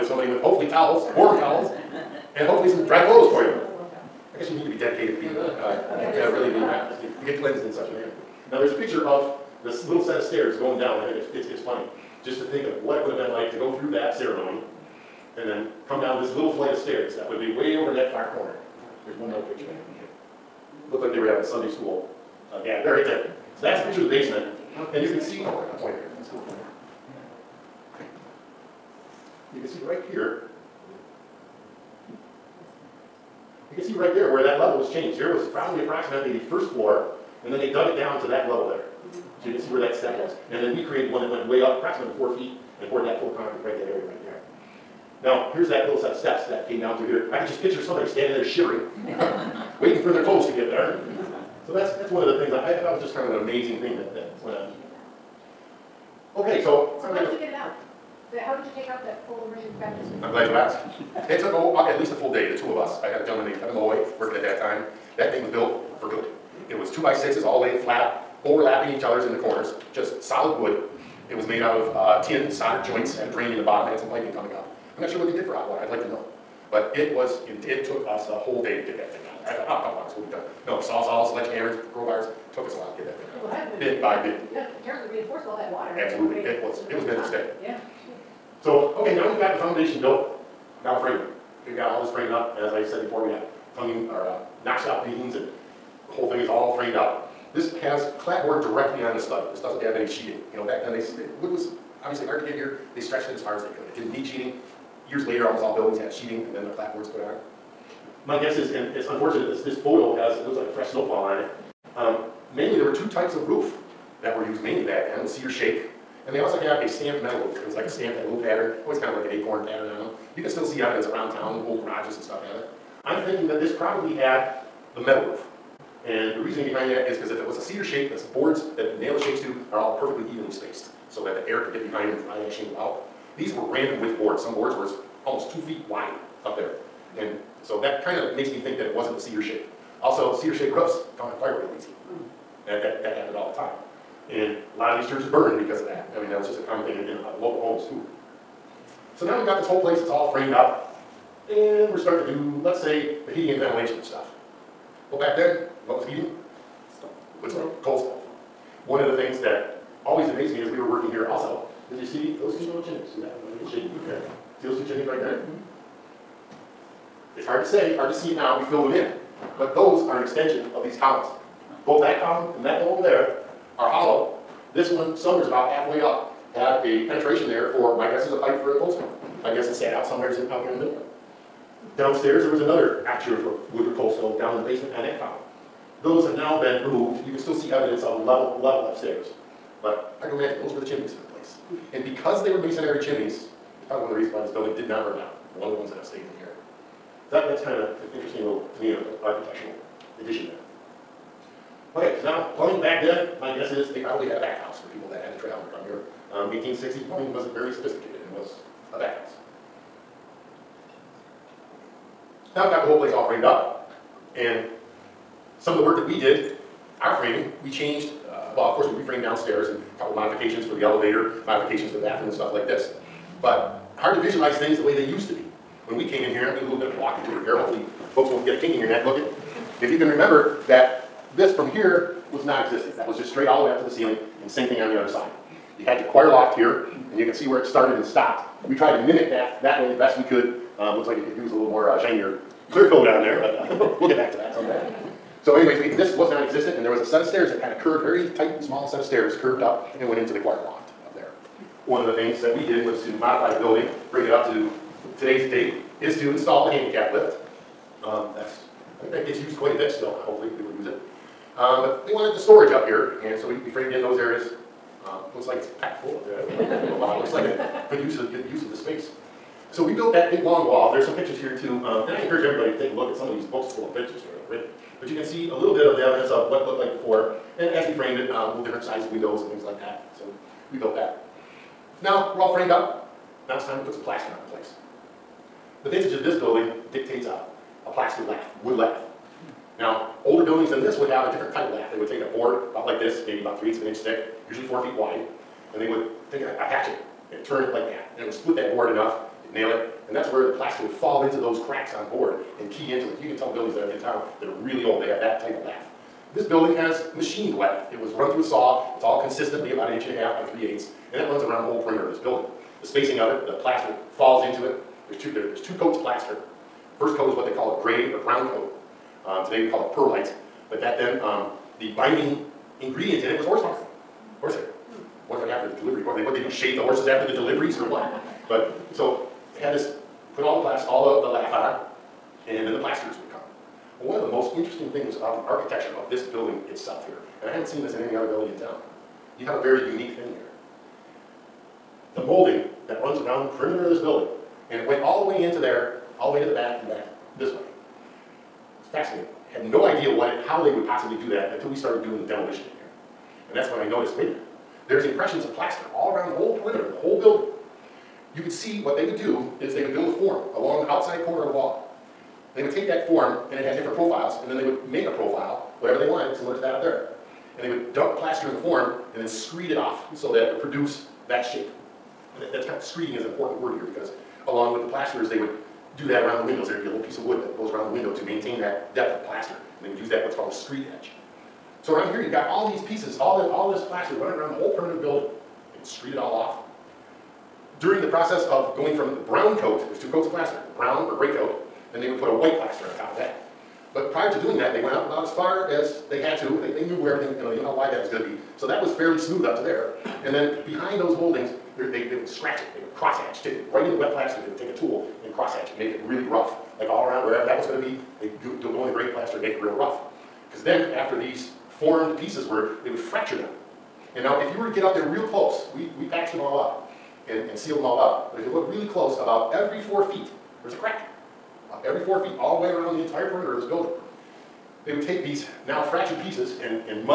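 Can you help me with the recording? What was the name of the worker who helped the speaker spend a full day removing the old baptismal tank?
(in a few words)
Kevin Malloy.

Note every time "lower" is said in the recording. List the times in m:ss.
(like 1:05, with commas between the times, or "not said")
not said.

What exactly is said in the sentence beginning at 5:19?
Um, today we call it perlite, but back then um, the binding ingredient in it was horsehair.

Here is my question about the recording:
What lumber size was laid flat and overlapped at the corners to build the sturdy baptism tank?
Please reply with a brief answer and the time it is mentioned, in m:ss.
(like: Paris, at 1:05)
two by sixes, at 1:06.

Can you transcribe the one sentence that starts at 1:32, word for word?
As I said before, we got tonguing or uh, notched out beams and the whole thing is all framed up.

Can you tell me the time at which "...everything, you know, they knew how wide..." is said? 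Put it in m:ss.
6:37.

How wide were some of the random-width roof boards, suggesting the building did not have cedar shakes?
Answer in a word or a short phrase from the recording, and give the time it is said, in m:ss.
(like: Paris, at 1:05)
2 feet, at 2:15.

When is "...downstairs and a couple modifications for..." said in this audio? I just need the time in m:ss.
3:39.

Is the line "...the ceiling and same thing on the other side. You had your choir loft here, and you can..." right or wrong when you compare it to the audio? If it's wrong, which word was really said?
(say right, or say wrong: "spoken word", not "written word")
right.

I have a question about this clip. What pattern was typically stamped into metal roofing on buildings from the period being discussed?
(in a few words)
acorn pattern.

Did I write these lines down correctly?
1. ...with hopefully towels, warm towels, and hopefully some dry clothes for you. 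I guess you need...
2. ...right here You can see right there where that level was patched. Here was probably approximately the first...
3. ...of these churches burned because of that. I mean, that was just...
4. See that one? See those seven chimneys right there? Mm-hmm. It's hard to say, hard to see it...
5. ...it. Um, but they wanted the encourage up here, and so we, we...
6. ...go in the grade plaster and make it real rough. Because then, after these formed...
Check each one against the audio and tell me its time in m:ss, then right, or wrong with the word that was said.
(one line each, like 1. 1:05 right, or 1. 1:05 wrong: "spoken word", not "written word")
1. 0:00 right
2. 0:29 wrong: "changed", not "patched"
3. 2:24 right
4. 2:43 wrong: "two", not "seven"
5. 4:20 wrong: "storage", not "encourage"
6. 6:48 right.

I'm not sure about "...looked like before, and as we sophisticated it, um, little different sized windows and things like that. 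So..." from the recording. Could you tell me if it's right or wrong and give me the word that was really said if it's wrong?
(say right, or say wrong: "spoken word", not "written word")
wrong: "framed", not "sophisticated".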